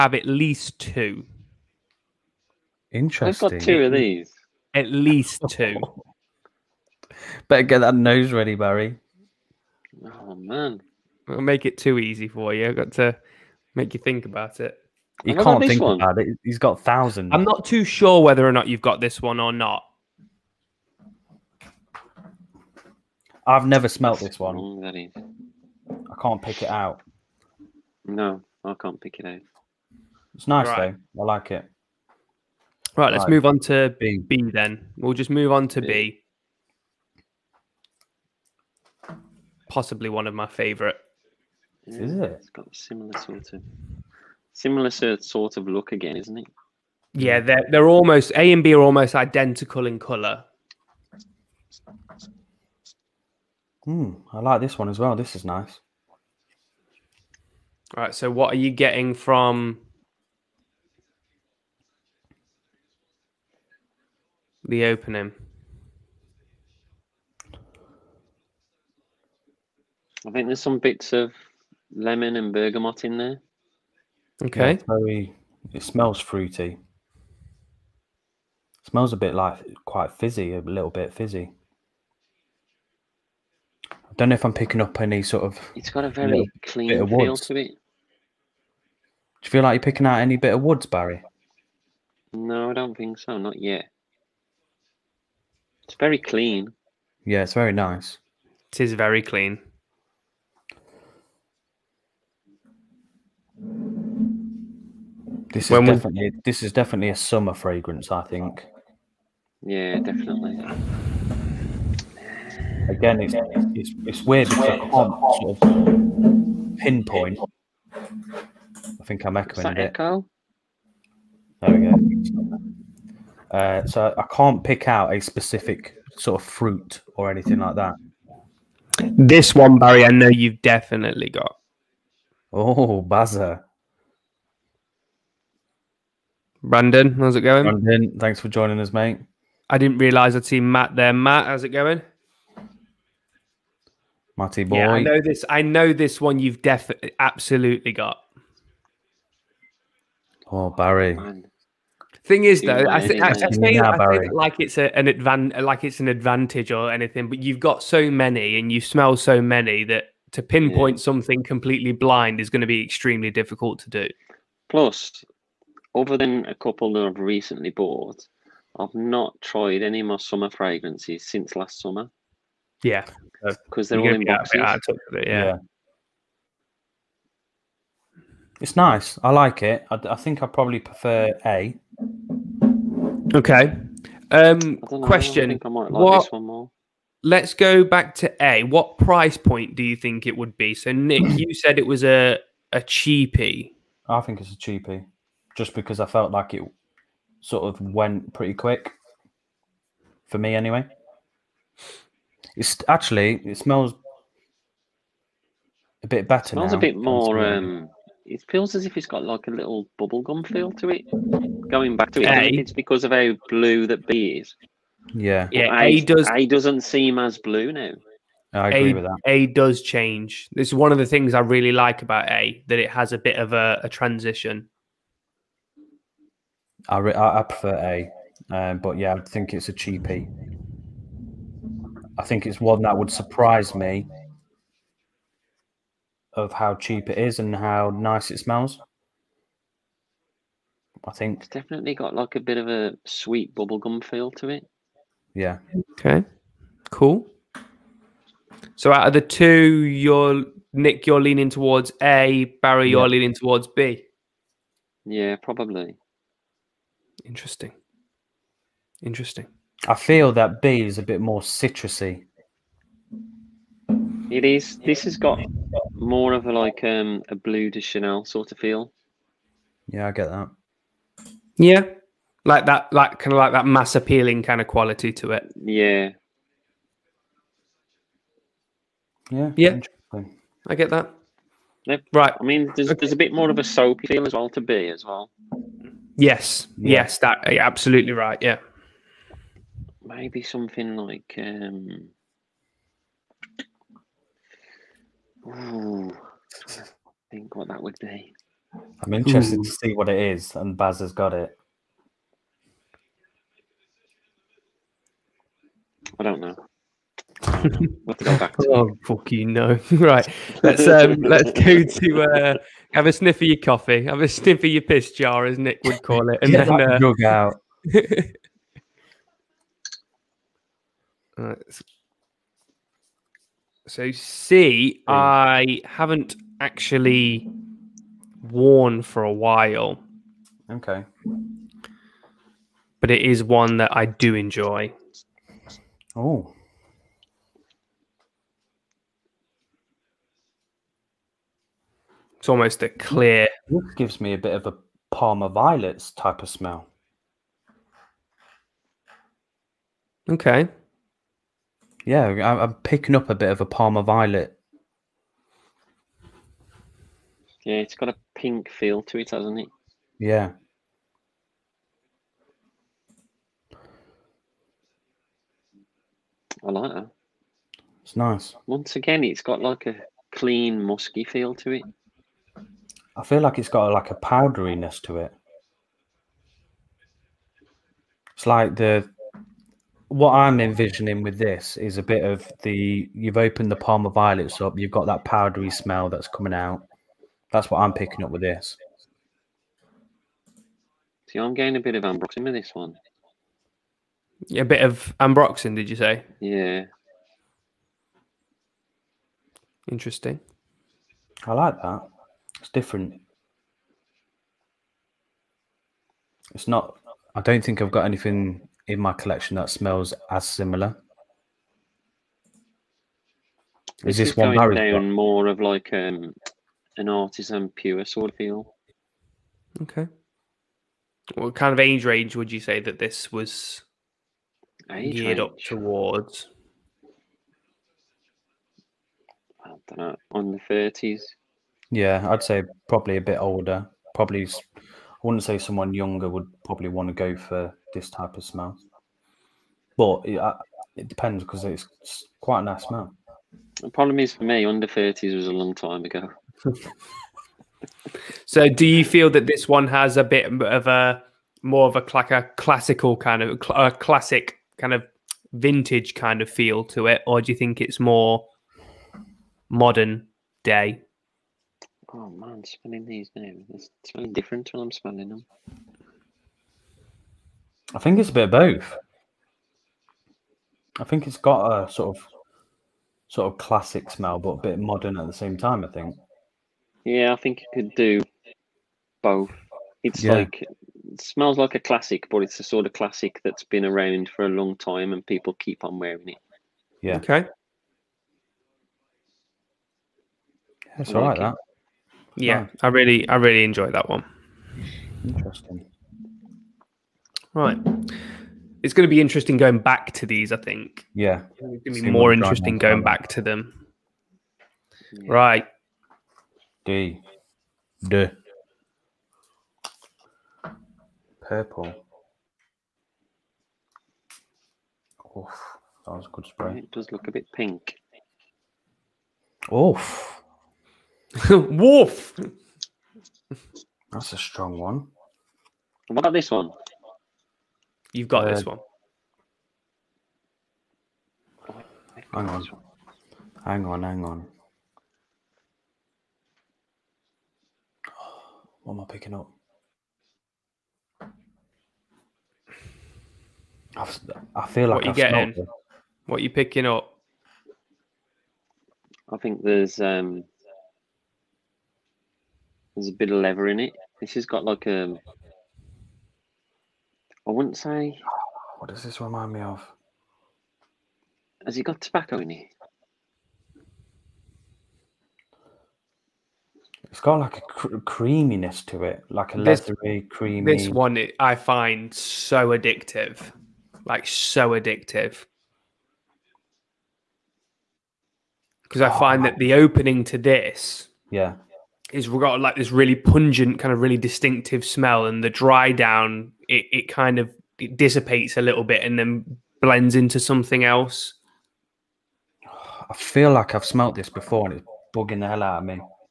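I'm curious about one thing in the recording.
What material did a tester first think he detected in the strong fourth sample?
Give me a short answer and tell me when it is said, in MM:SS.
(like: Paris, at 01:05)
leather, at 09:13.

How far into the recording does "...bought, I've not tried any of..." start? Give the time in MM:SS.
02:47.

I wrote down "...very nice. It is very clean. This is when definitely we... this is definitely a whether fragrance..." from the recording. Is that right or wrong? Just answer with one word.
wrong.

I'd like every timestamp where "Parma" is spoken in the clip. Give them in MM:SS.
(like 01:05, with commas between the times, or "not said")
05:45, 05:53, 06:23.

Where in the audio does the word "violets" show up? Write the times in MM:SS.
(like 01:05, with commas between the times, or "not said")
05:45, 05:54, 06:24.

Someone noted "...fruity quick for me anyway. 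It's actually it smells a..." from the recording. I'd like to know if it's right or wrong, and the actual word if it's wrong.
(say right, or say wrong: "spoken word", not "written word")
wrong: "pretty", not "fruity".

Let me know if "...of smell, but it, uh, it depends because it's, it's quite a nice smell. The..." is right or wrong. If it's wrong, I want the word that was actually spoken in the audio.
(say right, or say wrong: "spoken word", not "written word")
right.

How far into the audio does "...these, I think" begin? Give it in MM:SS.
08:20.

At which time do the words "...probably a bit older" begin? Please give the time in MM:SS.
07:12.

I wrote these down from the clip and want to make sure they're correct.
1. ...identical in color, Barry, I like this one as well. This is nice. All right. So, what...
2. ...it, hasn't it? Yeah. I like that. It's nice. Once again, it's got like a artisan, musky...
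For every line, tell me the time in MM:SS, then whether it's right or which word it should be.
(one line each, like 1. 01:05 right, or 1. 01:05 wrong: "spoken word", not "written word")
1. 00:49 wrong: "Hmm", not "Barry"
2. 05:59 wrong: "clean", not "artisan".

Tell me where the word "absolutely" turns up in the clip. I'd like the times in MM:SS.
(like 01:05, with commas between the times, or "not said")
02:27, 04:47.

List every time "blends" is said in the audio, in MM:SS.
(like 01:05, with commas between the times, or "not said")
09:49.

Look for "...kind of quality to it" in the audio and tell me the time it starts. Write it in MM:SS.
04:34.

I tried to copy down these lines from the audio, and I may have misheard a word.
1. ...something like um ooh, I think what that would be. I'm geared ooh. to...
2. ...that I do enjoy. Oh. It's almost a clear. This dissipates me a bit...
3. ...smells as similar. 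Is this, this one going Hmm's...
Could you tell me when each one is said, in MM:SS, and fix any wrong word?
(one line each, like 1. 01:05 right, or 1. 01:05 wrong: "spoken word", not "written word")
1. 04:50 wrong: "interested", not "geared"
2. 05:33 wrong: "gives", not "dissipates"
3. 06:49 wrong: "Barry", not "Hmm".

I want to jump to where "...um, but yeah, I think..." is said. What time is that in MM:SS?
03:48.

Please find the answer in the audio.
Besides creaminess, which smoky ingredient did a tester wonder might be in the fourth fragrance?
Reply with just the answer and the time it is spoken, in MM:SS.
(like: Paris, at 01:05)
tobacco, at 09:21.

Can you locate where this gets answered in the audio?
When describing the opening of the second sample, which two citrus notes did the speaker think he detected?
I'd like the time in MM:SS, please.
01:11.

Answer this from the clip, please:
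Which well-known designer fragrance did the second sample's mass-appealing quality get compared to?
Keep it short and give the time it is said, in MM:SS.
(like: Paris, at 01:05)
Bleu de Chanel, at 04:27.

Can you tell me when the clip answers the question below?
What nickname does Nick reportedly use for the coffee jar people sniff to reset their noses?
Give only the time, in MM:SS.
05:14.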